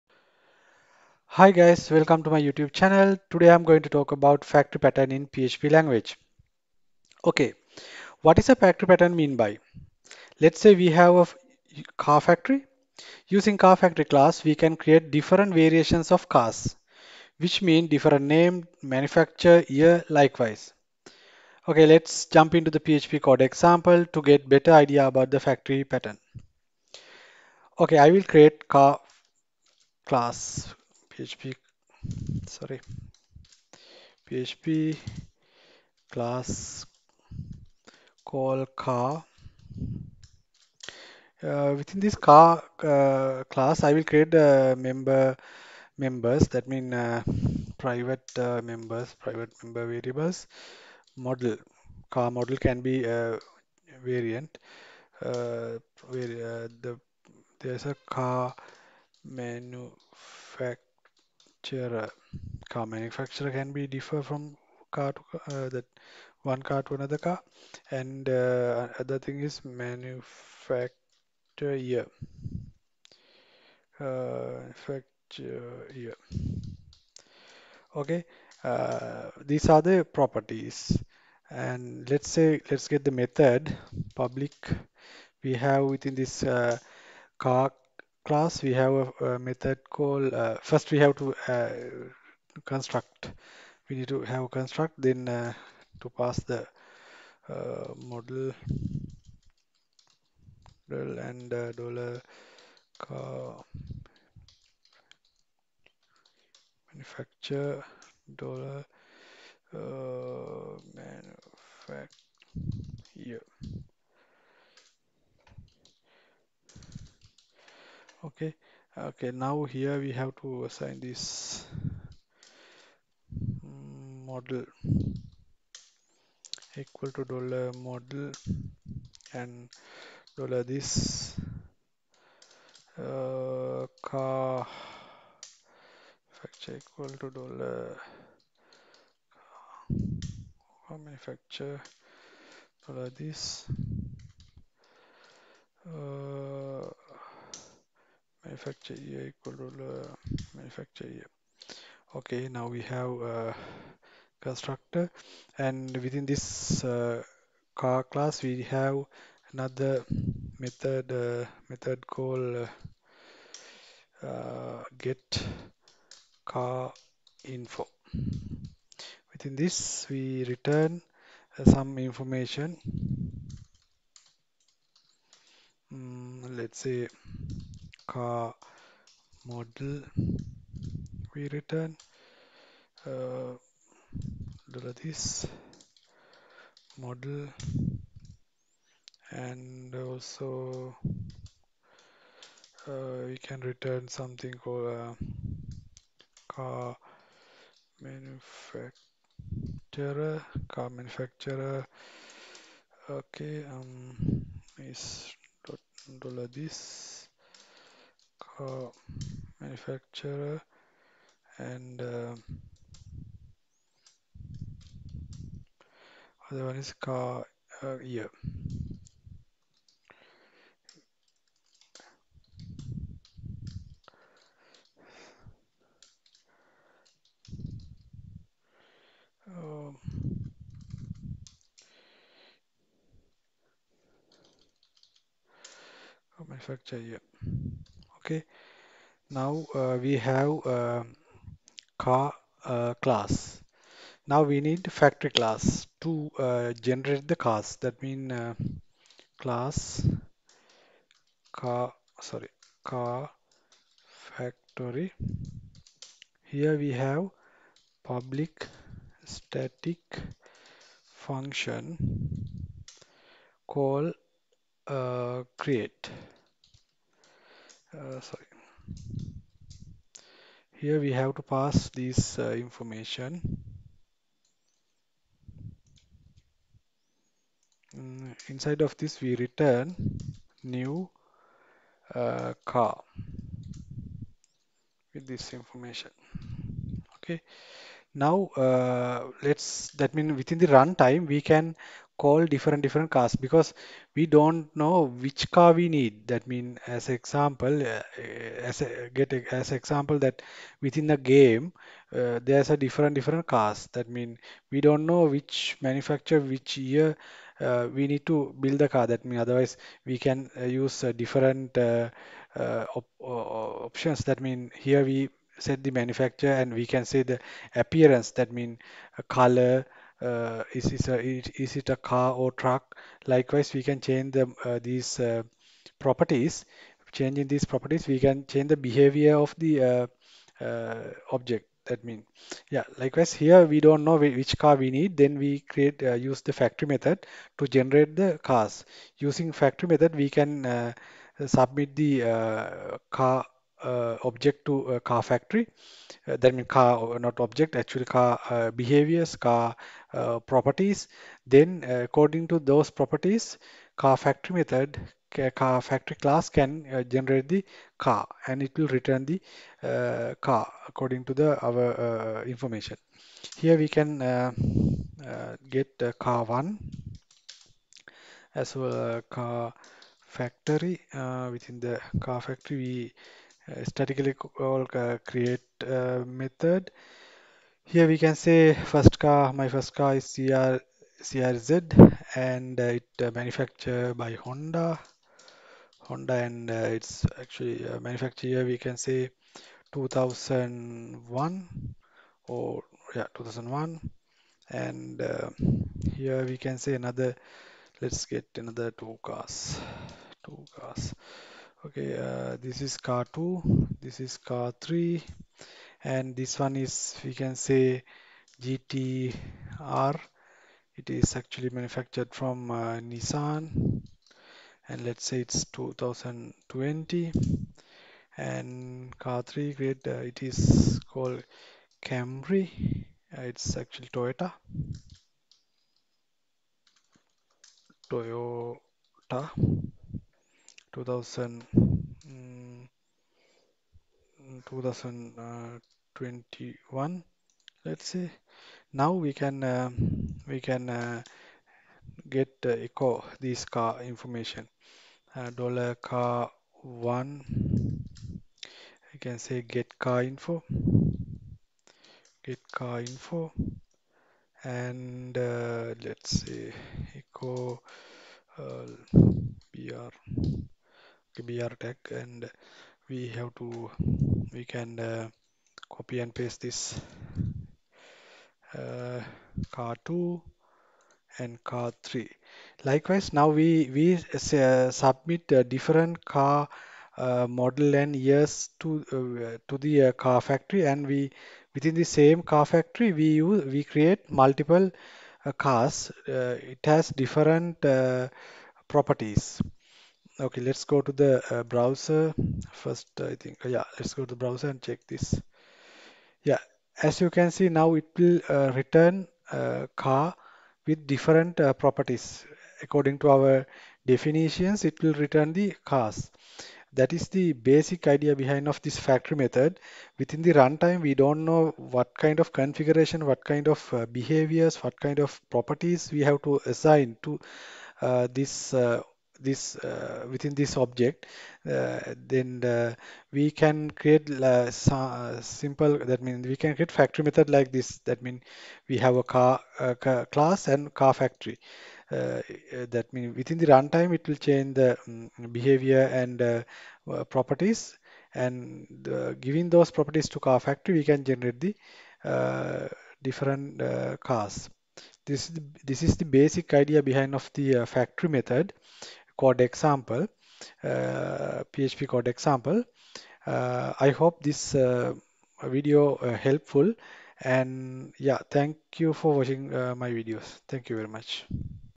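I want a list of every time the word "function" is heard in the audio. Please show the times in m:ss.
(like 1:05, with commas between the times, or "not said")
4:21.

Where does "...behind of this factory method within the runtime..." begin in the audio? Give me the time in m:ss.
8:28.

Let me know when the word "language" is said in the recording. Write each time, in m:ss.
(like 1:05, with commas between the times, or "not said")
0:05.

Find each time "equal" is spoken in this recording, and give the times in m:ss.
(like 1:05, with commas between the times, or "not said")
2:06, 2:16, 2:28.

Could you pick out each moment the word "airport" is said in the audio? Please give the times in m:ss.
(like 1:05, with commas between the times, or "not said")
not said.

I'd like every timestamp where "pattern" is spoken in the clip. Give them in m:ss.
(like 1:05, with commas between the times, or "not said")
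0:04, 0:08, 0:25.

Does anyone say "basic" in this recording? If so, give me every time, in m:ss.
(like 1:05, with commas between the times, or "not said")
8:27, 9:06.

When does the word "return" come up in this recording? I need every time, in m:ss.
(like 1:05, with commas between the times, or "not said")
2:50, 3:01, 3:13, 4:39, 5:58, 8:18, 8:25.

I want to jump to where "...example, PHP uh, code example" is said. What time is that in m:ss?
9:09.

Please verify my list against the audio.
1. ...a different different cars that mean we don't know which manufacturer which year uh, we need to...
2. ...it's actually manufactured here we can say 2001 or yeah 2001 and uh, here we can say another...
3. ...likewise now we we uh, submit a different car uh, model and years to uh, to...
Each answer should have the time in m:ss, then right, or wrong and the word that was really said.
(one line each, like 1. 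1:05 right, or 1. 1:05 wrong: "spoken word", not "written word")
1. 5:02 right
2. 6:26 right
3. 7:52 right.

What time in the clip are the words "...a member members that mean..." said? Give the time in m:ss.
0:44.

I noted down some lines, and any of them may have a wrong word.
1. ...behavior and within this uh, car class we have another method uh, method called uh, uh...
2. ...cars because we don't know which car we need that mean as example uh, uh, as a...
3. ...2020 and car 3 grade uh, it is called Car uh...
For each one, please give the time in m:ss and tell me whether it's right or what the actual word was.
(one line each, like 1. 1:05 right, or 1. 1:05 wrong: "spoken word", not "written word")
1. 2:34 wrong: "constructor", not "behavior"
2. 4:53 right
3. 6:55 wrong: "Camry", not "Car".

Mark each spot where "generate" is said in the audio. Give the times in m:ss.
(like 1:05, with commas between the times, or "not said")
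4:06, 5:37, 5:57, 9:01.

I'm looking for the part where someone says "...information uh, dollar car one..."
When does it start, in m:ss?
7:24.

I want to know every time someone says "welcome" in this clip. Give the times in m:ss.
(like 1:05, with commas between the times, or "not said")
0:01.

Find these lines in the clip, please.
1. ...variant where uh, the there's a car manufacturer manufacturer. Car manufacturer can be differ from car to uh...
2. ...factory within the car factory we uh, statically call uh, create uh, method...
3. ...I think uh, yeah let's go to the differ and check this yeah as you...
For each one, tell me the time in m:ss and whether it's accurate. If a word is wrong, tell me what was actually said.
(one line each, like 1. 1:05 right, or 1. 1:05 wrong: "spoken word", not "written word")
1. 0:54 right
2. 6:10 right
3. 8:13 wrong: "browser", not "differ".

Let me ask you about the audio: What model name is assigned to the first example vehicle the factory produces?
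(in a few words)
CRZ.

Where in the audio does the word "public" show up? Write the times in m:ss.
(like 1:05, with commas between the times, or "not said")
1:24, 4:18.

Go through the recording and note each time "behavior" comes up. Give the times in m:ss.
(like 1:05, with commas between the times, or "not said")
5:28, 5:48, 8:34, 8:55.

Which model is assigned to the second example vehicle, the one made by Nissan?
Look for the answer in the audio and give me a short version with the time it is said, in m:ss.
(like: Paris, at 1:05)
GTR, at 6:48.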